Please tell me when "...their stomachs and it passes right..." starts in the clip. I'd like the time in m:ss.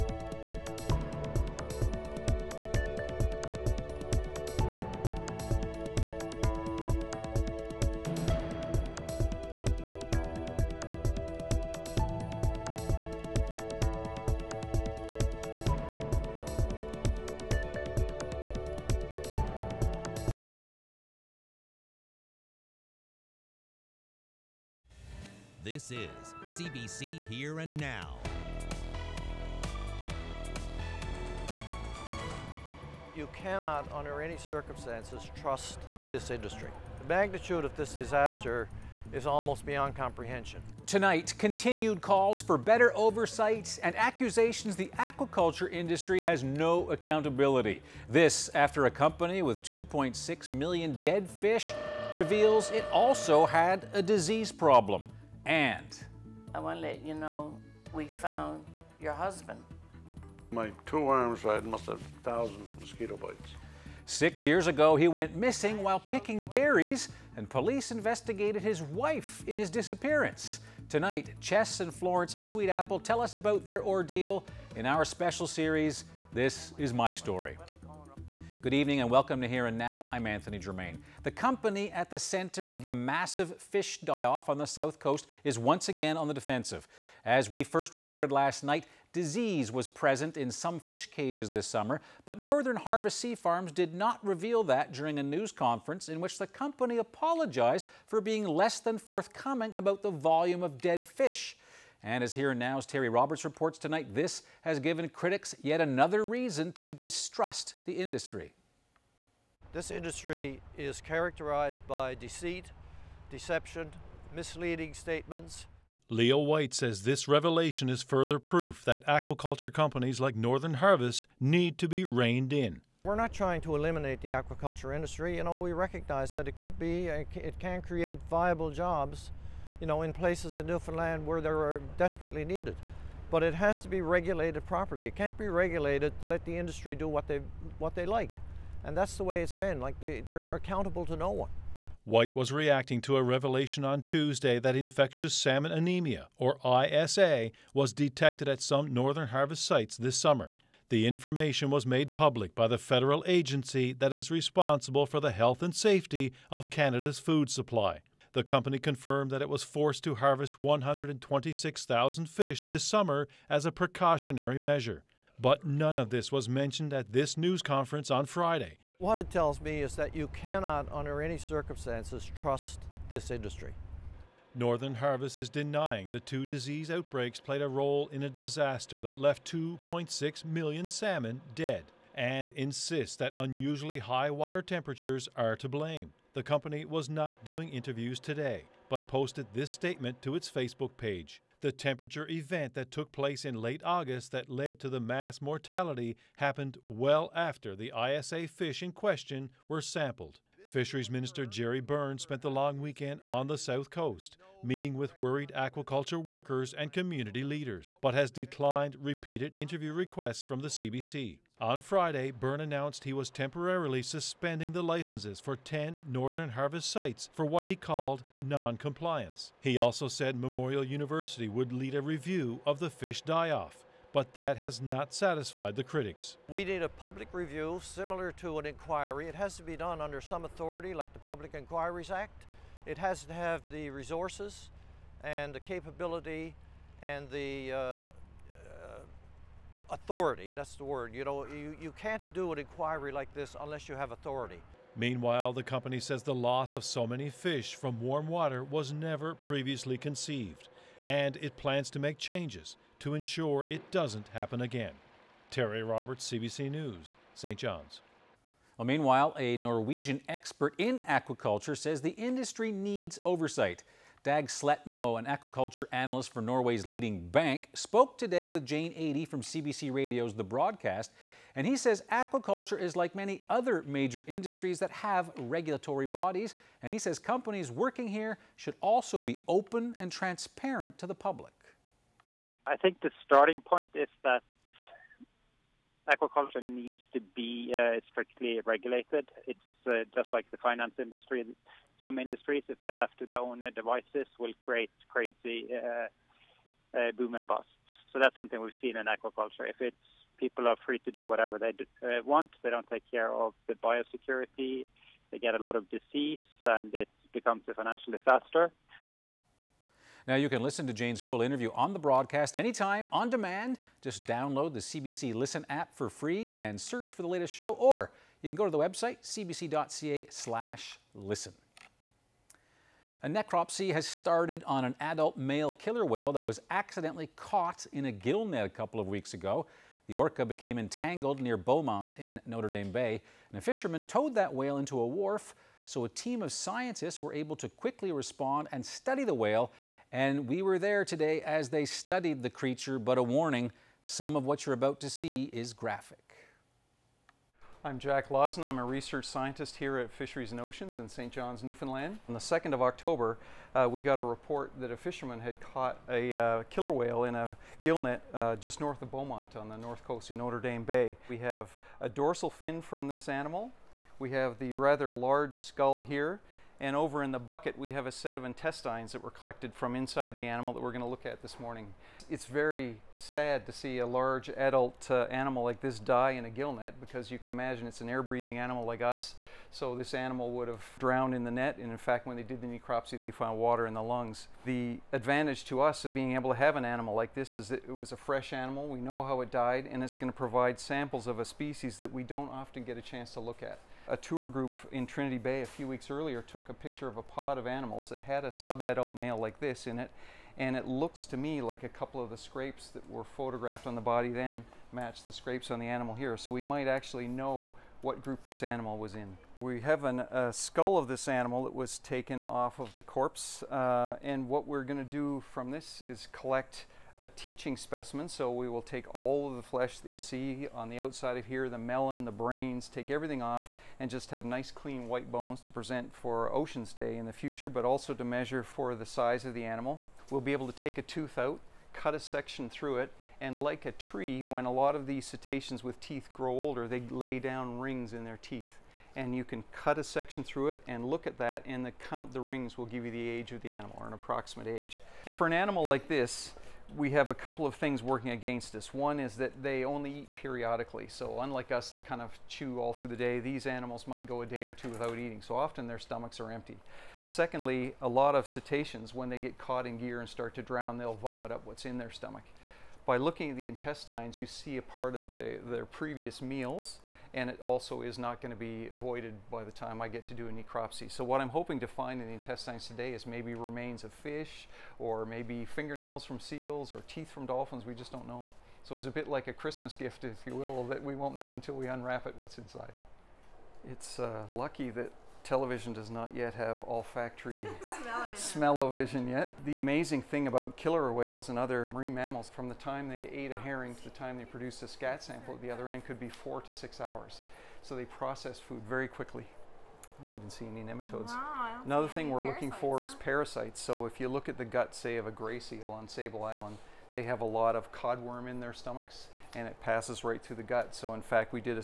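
8:28.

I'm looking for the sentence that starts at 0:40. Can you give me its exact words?
Tonight, continued calls for better oversight and accusations the aquaculture industry has no accountability.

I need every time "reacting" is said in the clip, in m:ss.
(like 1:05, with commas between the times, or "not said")
2:22.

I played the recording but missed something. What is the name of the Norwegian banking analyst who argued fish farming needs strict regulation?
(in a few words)
Dag Sletmo.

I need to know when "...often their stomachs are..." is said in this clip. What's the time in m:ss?
7:35.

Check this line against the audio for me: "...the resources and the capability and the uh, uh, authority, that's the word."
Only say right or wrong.
right.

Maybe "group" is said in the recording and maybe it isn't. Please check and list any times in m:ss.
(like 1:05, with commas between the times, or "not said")
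6:34, 6:48.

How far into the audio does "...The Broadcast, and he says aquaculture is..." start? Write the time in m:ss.
4:30.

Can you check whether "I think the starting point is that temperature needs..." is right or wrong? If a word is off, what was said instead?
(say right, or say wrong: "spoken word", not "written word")
wrong: "aquaculture", not "temperature".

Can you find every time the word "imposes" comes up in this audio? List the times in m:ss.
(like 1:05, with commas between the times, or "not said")
not said.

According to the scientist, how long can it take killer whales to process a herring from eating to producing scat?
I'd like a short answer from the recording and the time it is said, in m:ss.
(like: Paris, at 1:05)
4 to 6 hours, at 8:16.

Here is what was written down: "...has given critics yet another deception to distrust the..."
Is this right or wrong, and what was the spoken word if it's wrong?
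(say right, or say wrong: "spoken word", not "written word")
wrong: "reason", not "deception".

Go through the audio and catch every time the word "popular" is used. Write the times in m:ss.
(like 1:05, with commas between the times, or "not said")
not said.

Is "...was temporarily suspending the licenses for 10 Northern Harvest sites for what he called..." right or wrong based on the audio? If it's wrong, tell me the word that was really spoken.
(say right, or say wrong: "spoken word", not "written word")
right.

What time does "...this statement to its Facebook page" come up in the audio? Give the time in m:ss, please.
3:09.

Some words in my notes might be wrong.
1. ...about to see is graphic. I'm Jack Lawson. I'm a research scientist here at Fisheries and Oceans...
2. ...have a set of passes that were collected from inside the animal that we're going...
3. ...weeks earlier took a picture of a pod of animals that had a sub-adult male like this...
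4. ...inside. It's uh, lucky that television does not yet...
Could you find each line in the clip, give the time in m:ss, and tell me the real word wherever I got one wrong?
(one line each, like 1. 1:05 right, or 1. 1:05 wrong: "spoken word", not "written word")
1. 5:44 right
2. 6:07 wrong: "intestines", not "passes"
3. 6:35 right
4. 8:02 right.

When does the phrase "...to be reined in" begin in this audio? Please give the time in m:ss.
2:01.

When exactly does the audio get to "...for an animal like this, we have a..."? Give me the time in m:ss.
7:25.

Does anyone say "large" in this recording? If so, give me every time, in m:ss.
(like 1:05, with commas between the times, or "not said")
6:05, 6:14.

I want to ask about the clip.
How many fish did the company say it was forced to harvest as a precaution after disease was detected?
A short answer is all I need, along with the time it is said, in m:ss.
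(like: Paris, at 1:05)
126,000, at 2:40.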